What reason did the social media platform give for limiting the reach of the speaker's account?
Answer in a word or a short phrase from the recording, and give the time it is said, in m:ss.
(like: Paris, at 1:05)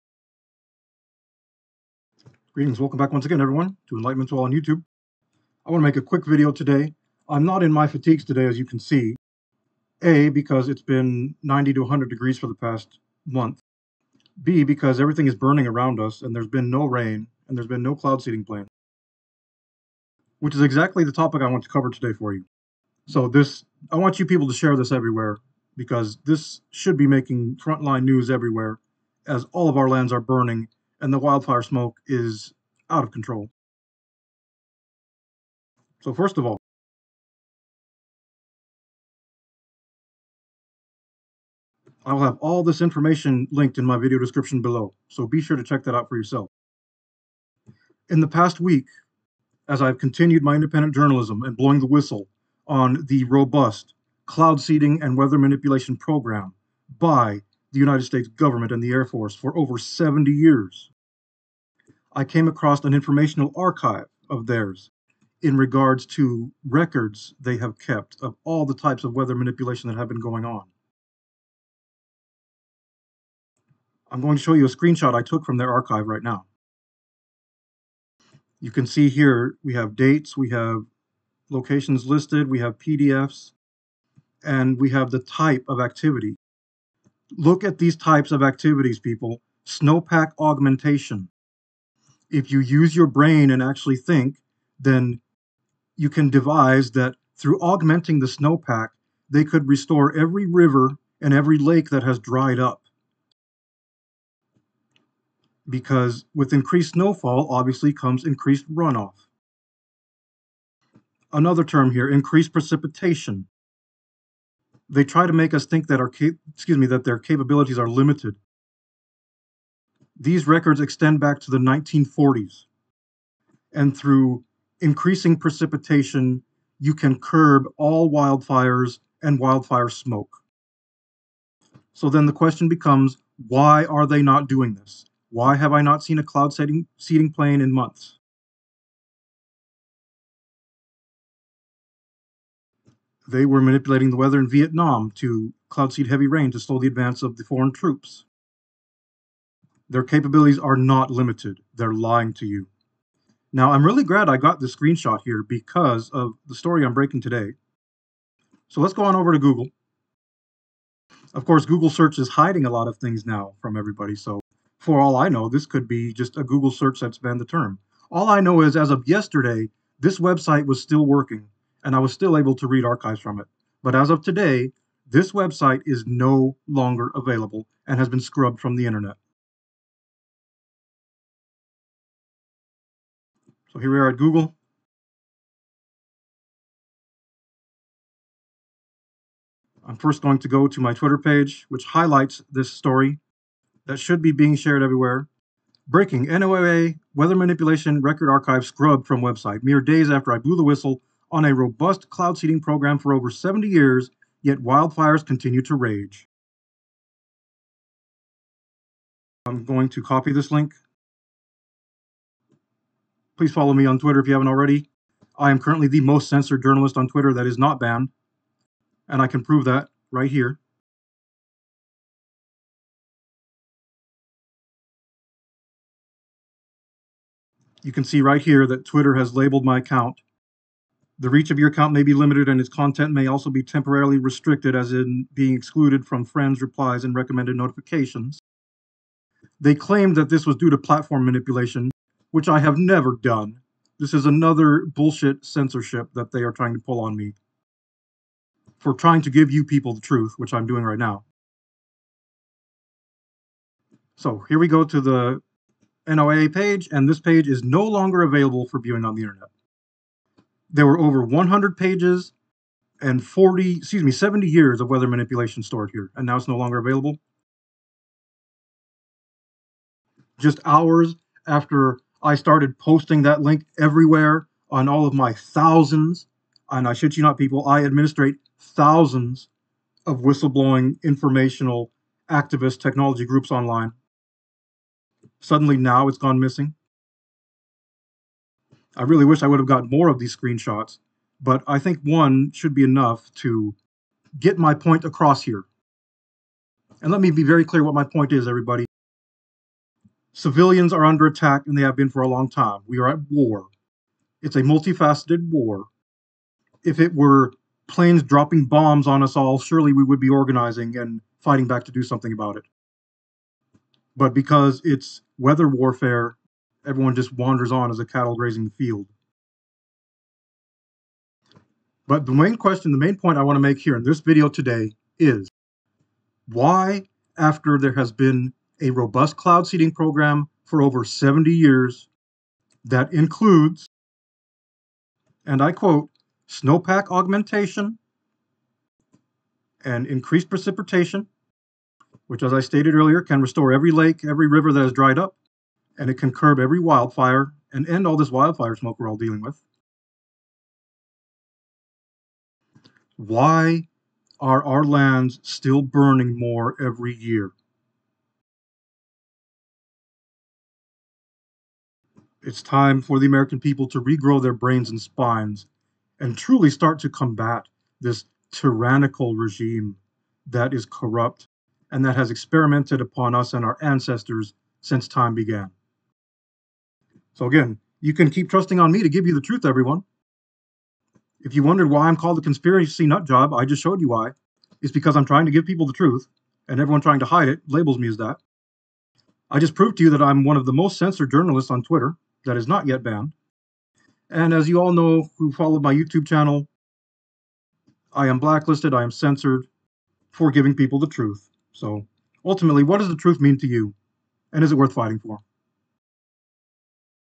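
platform manipulation, at 4:00.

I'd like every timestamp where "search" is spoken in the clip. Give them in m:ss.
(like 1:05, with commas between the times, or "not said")
2:41, 2:46.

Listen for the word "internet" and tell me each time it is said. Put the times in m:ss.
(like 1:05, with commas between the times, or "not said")
2:58, 4:19.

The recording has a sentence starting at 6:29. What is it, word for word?
I just proved to you that I'm one of the most censored journalists on Twitter, that is not yet banned.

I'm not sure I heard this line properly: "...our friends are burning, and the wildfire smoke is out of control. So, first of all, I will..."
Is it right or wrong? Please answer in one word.
wrong.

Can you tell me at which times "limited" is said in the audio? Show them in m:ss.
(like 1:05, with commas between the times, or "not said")
1:57, 2:31, 3:52.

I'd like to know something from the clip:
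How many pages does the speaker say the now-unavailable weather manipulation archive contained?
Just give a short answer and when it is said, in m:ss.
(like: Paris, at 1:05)
over 100 pages, at 4:20.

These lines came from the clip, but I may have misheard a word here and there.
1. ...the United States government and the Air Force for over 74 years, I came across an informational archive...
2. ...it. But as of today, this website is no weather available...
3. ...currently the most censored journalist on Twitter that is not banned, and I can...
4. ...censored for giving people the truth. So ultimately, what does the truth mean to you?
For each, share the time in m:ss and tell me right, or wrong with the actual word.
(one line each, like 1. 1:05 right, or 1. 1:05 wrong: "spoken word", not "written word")
1. 0:57 wrong: "70", not "74"
2. 2:53 wrong: "longer", not "weather"
3. 3:35 right
4. 6:39 right.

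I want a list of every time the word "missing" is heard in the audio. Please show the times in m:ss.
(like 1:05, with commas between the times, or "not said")
4:46.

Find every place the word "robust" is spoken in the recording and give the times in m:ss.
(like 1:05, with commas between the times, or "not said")
0:53, 3:21, 5:28.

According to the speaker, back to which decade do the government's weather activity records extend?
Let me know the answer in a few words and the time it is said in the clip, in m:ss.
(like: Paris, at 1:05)
1940s, at 2:01.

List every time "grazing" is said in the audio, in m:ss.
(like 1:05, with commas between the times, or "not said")
5:18.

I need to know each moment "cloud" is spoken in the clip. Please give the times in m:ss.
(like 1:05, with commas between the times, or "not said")
0:17, 0:54, 2:16, 2:25, 3:22, 5:29.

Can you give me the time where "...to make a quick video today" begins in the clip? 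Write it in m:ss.
0:05.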